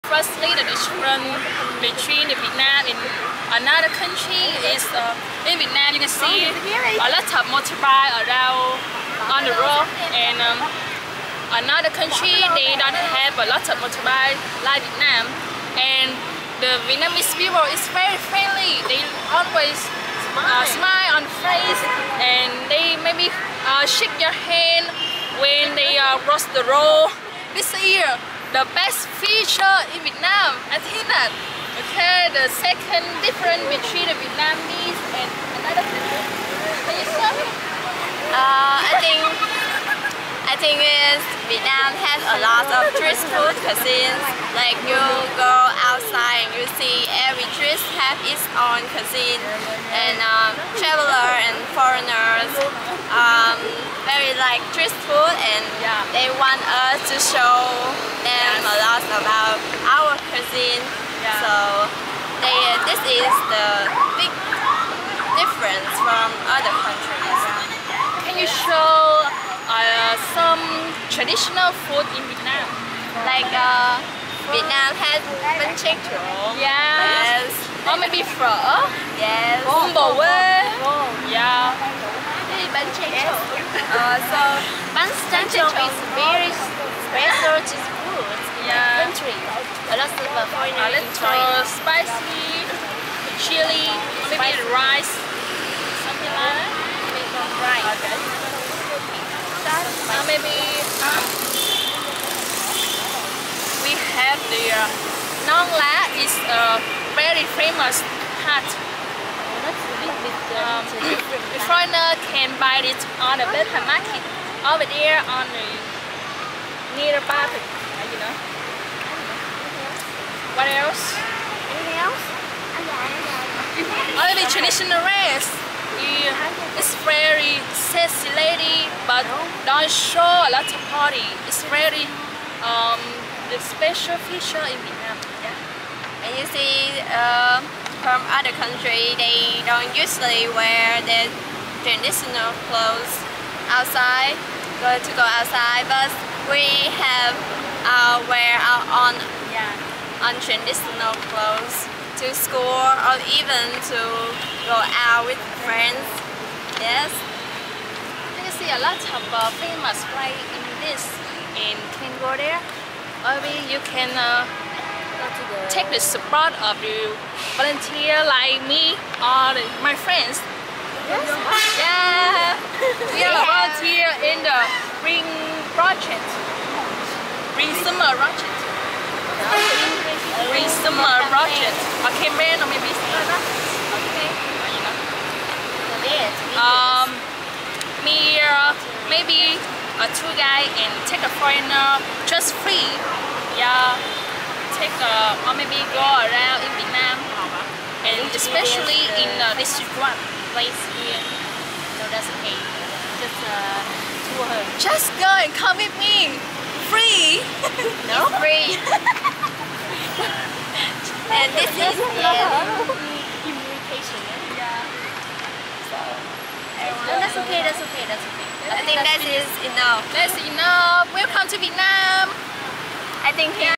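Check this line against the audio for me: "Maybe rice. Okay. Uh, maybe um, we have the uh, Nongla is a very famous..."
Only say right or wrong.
right.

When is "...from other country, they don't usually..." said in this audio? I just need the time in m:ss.
2:18.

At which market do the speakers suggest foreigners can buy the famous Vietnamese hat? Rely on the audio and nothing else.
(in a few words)
Bến Thành market.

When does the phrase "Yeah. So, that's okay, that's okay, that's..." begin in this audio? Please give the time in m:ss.
3:34.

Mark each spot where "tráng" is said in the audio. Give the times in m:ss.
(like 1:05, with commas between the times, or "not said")
1:15, 1:25.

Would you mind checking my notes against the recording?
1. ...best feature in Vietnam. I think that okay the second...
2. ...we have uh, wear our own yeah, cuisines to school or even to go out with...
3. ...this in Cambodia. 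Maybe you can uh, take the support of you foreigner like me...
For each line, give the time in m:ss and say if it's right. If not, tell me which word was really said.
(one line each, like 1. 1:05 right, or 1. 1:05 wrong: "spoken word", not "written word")
1. 0:28 right
2. 2:26 wrong: "clothes", not "cuisines"
3. 2:40 wrong: "volunteer", not "foreigner".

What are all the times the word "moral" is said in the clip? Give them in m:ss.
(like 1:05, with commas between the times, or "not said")
not said.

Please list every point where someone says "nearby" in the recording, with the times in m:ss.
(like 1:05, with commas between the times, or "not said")
1:56.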